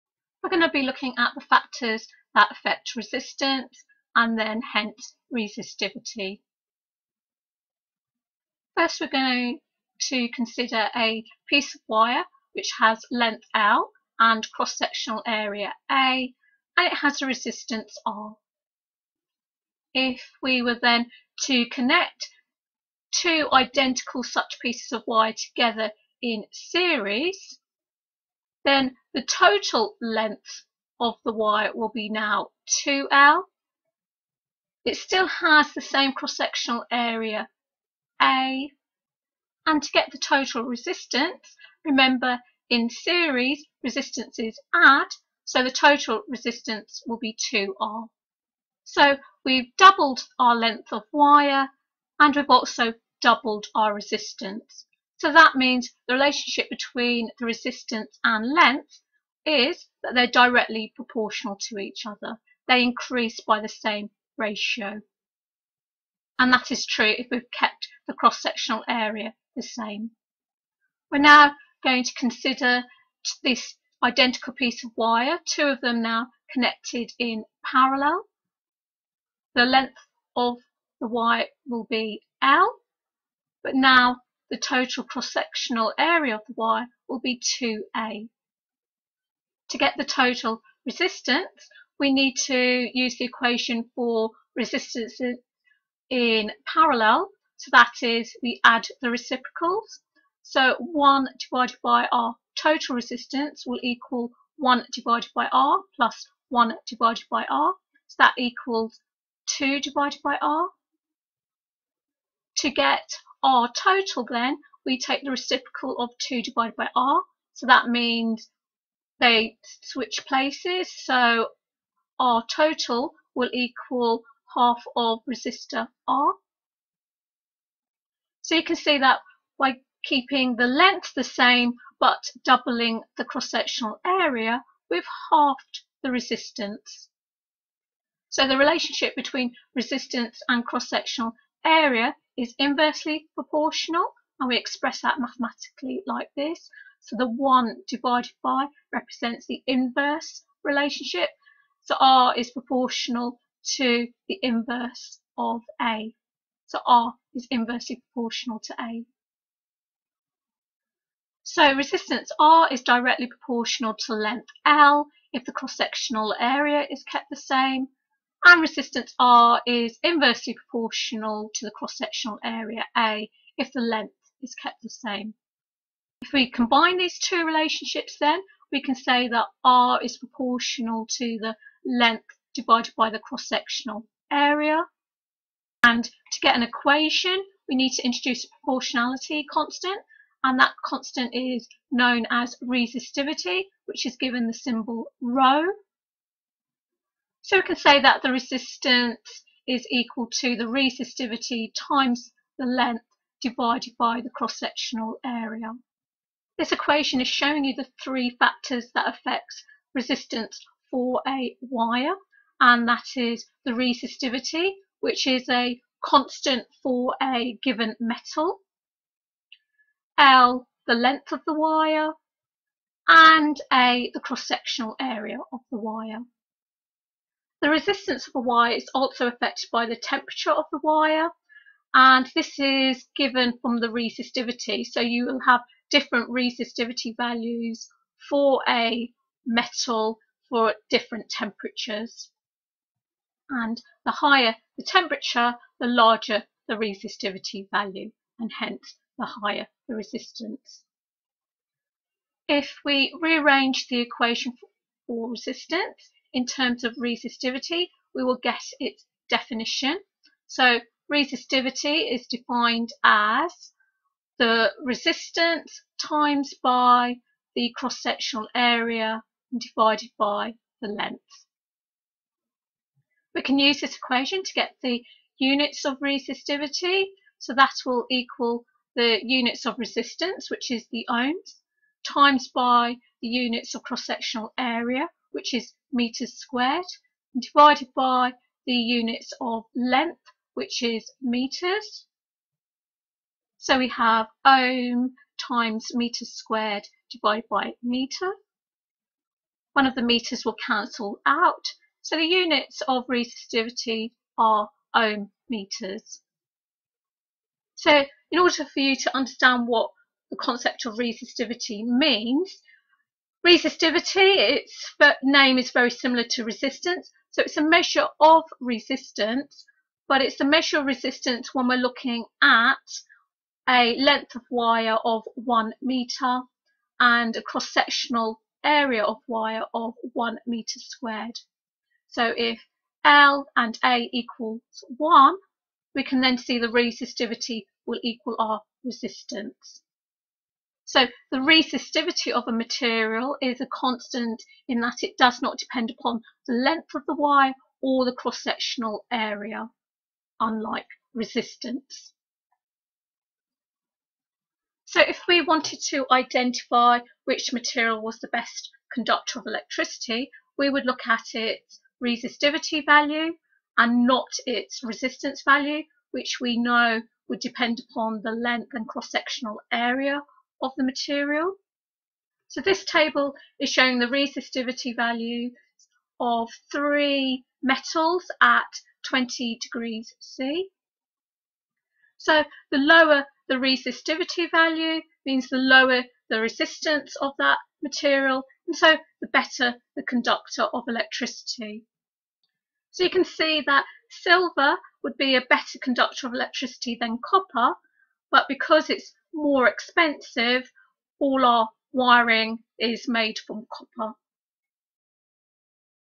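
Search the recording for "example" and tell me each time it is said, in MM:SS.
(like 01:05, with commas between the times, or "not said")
not said.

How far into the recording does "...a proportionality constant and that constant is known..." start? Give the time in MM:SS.
03:08.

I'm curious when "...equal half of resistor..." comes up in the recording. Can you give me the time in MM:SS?
02:03.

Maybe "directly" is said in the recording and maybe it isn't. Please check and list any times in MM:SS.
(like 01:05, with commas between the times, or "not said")
01:00, 02:42.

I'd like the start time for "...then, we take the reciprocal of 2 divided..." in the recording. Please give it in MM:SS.
01:54.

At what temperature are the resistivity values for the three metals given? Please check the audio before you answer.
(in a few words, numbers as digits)
20 degrees C.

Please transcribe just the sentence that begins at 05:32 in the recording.
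So if L and A equals one, we can then see the resistivity will equal our resistance.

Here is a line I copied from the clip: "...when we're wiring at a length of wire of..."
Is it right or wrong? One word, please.
wrong.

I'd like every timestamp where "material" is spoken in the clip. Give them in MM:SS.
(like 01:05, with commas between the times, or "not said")
05:42, 05:57, 06:10, 06:27.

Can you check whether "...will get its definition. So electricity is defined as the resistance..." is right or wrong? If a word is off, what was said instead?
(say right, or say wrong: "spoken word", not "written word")
wrong: "resistivity", not "electricity".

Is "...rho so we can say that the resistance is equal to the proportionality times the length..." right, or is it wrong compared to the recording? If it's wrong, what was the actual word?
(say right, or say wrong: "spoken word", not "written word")
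wrong: "resistivity", not "proportionality".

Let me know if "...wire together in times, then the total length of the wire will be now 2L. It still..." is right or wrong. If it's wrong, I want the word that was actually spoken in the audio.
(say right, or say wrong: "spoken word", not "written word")
wrong: "series", not "times".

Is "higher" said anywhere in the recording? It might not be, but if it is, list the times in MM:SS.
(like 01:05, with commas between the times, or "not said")
04:04, 04:09.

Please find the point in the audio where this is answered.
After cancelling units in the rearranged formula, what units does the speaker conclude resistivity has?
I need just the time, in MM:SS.
05:04.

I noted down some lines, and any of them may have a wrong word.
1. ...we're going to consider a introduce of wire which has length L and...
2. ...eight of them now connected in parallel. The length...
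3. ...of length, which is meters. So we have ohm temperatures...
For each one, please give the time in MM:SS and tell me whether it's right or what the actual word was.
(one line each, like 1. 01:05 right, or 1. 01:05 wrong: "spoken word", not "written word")
1. 00:08 wrong: "piece", not "introduce"
2. 01:15 wrong: "two", not "eight"
3. 04:49 wrong: "times", not "temperatures".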